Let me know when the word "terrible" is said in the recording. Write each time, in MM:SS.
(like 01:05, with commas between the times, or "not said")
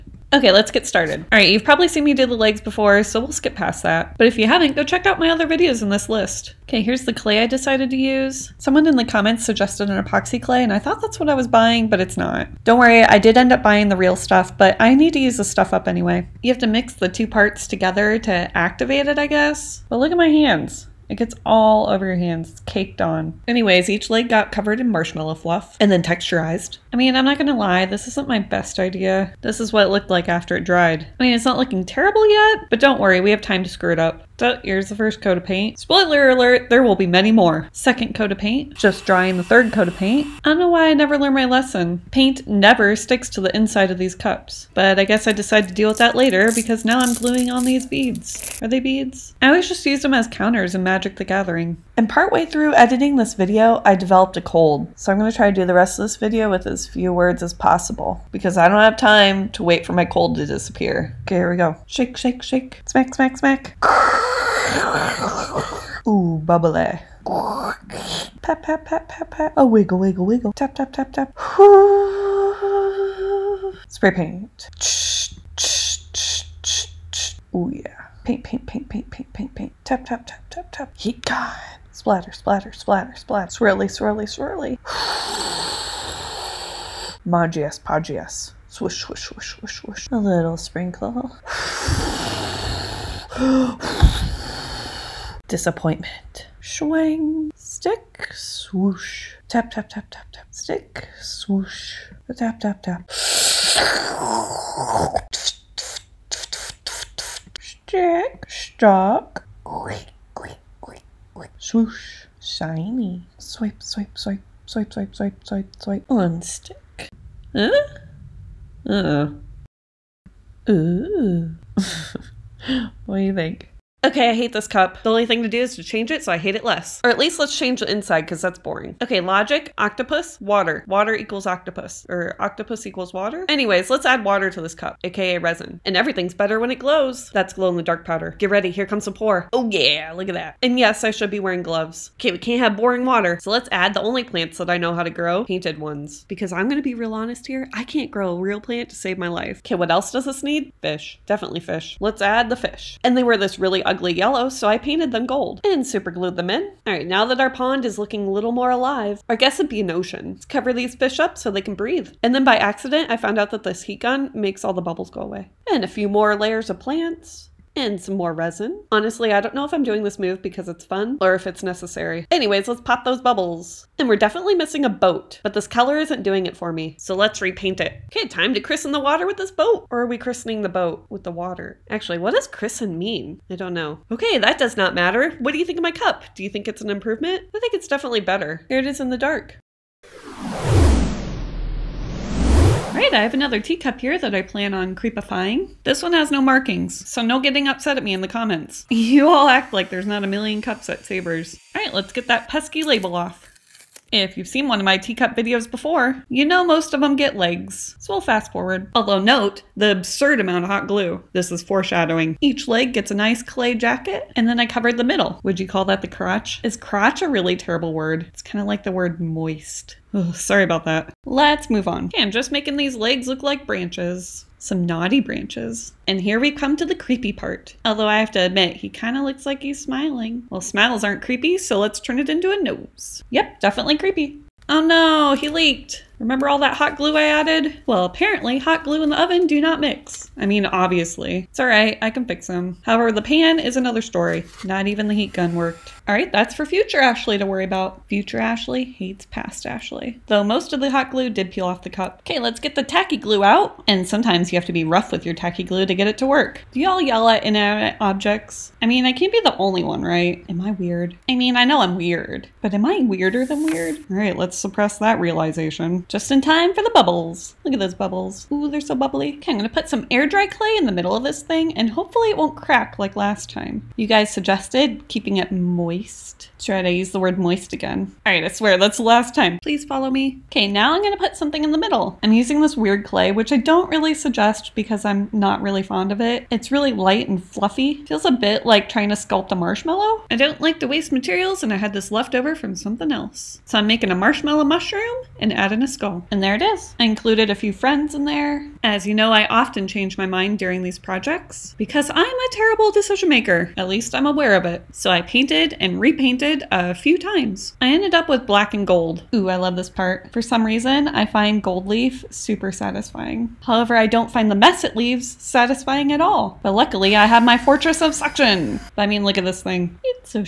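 00:31, 03:37, 05:02.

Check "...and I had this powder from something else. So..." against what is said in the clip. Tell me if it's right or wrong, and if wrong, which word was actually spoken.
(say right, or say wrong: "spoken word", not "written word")
wrong: "leftover", not "powder".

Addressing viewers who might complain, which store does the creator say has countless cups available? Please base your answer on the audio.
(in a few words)
Savers.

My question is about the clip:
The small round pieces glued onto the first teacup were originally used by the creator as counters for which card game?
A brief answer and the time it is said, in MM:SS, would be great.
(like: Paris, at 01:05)
Magic the Gathering, at 00:50.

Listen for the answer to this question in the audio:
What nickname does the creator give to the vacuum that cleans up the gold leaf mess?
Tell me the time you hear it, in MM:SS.
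05:17.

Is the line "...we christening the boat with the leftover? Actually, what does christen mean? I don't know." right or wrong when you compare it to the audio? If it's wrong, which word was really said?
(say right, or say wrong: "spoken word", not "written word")
wrong: "water", not "leftover".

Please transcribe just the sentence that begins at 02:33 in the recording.
And they were this really ugly ugly yellow, so I painted them gold and superglued them in.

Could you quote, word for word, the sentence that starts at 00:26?
I mean, I'm not gonna lie, this isn't my best idea.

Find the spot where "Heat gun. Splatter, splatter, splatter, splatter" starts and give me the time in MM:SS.
01:20.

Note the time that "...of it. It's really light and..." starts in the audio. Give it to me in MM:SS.
04:46.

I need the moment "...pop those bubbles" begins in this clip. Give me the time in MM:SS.
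02:52.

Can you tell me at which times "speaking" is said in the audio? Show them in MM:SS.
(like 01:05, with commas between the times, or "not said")
not said.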